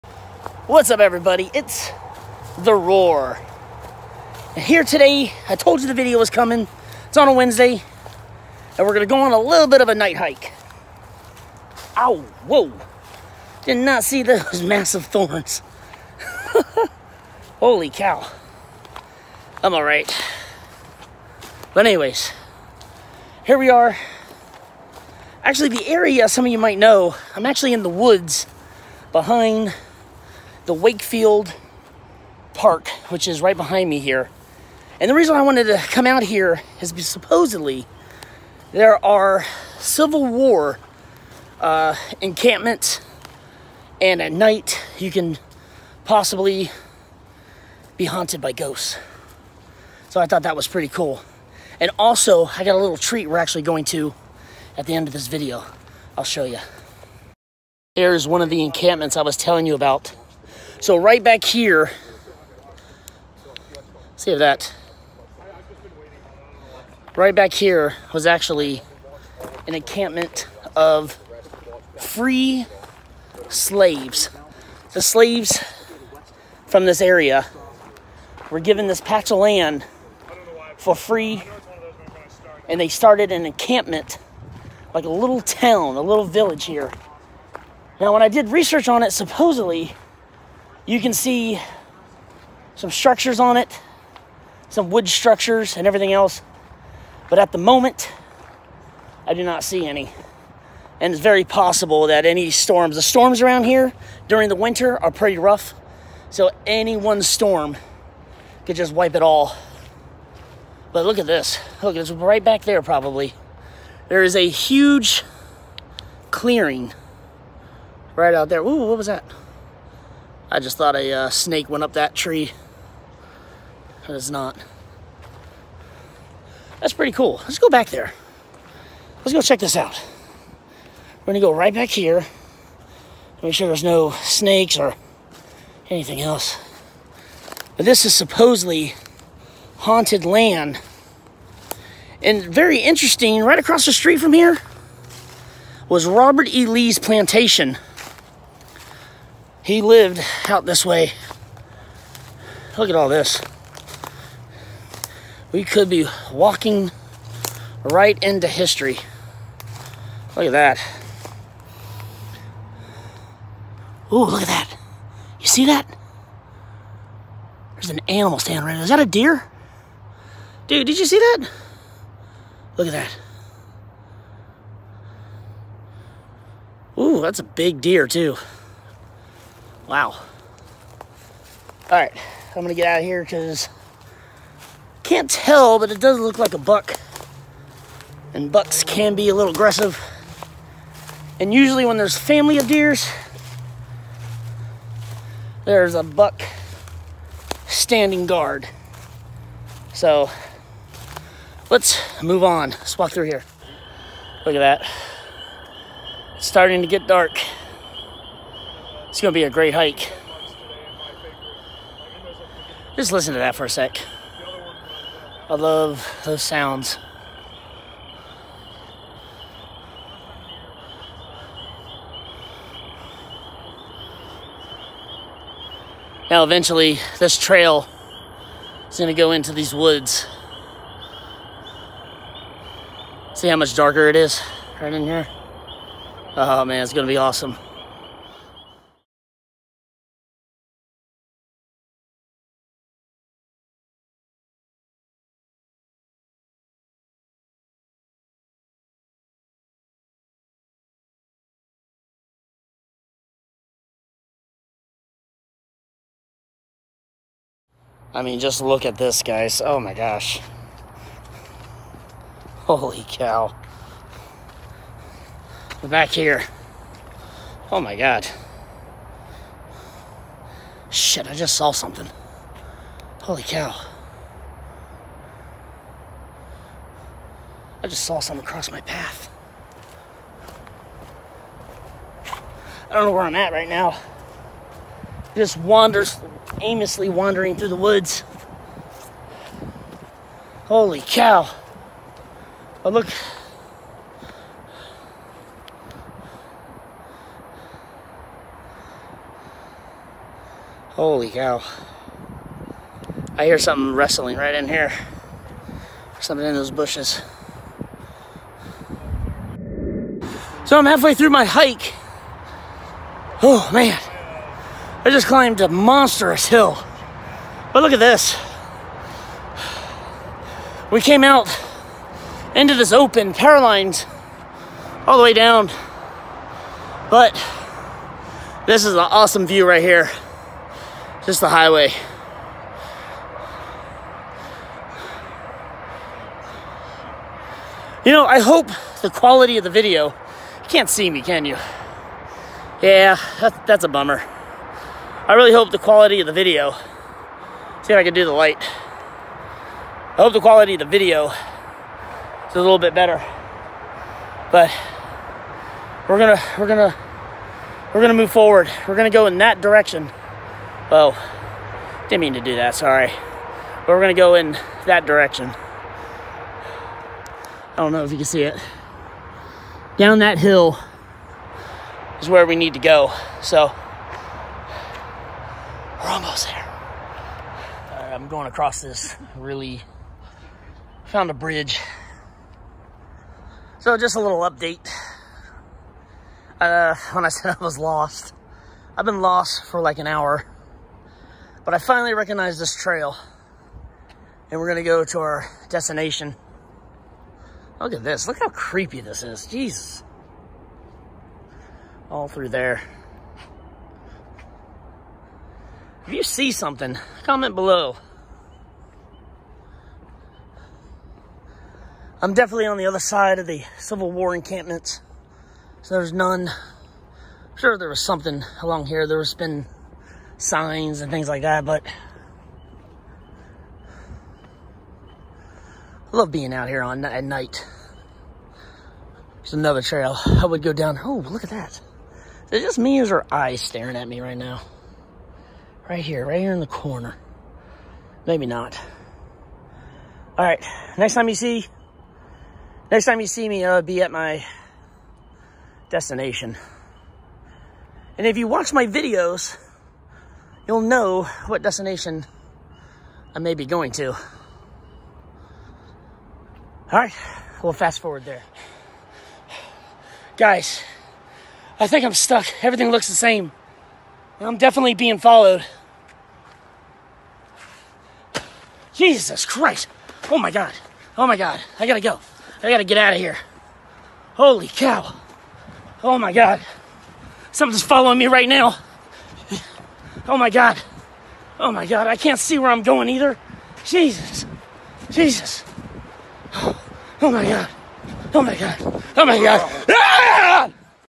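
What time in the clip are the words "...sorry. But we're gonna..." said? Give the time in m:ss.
6:02.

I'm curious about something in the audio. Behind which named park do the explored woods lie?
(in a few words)
Wakefield Park.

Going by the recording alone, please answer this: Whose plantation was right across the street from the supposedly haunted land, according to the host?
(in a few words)
Robert E. Lee.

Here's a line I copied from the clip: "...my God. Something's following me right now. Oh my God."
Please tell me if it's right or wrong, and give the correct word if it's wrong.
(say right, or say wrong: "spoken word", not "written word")
right.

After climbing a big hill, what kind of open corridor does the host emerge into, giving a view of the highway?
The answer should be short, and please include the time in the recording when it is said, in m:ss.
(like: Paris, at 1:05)
power lines, at 5:23.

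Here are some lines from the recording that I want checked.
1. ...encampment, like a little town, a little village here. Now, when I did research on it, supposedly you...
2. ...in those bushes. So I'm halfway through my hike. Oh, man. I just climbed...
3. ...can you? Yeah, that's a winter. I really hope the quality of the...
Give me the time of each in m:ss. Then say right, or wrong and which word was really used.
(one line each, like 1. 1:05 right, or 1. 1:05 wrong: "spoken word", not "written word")
1. 1:23 right
2. 5:06 right
3. 5:41 wrong: "bummer", not "winter".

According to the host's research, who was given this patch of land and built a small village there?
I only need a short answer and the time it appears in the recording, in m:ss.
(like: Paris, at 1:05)
free slaves, at 1:11.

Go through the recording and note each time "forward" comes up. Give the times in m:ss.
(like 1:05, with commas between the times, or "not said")
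5:58, 7:37.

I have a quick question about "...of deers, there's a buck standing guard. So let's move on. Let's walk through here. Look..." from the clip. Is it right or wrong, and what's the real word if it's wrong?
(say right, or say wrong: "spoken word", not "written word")
right.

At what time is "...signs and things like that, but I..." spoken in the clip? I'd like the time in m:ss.
7:00.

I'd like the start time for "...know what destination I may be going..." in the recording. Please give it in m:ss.
7:30.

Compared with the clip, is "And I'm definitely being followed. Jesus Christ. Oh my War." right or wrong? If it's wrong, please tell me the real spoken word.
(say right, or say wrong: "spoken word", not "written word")
wrong: "God", not "War".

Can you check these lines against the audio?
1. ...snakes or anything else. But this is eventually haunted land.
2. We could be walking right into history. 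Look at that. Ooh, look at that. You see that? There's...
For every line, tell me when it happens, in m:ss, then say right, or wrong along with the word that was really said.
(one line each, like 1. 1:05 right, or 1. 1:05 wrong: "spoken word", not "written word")
1. 2:14 wrong: "supposedly", not "eventually"
2. 2:35 right.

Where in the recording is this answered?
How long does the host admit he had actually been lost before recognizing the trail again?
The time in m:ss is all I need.
6:29.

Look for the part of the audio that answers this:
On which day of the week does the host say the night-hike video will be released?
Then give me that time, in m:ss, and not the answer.
0:07.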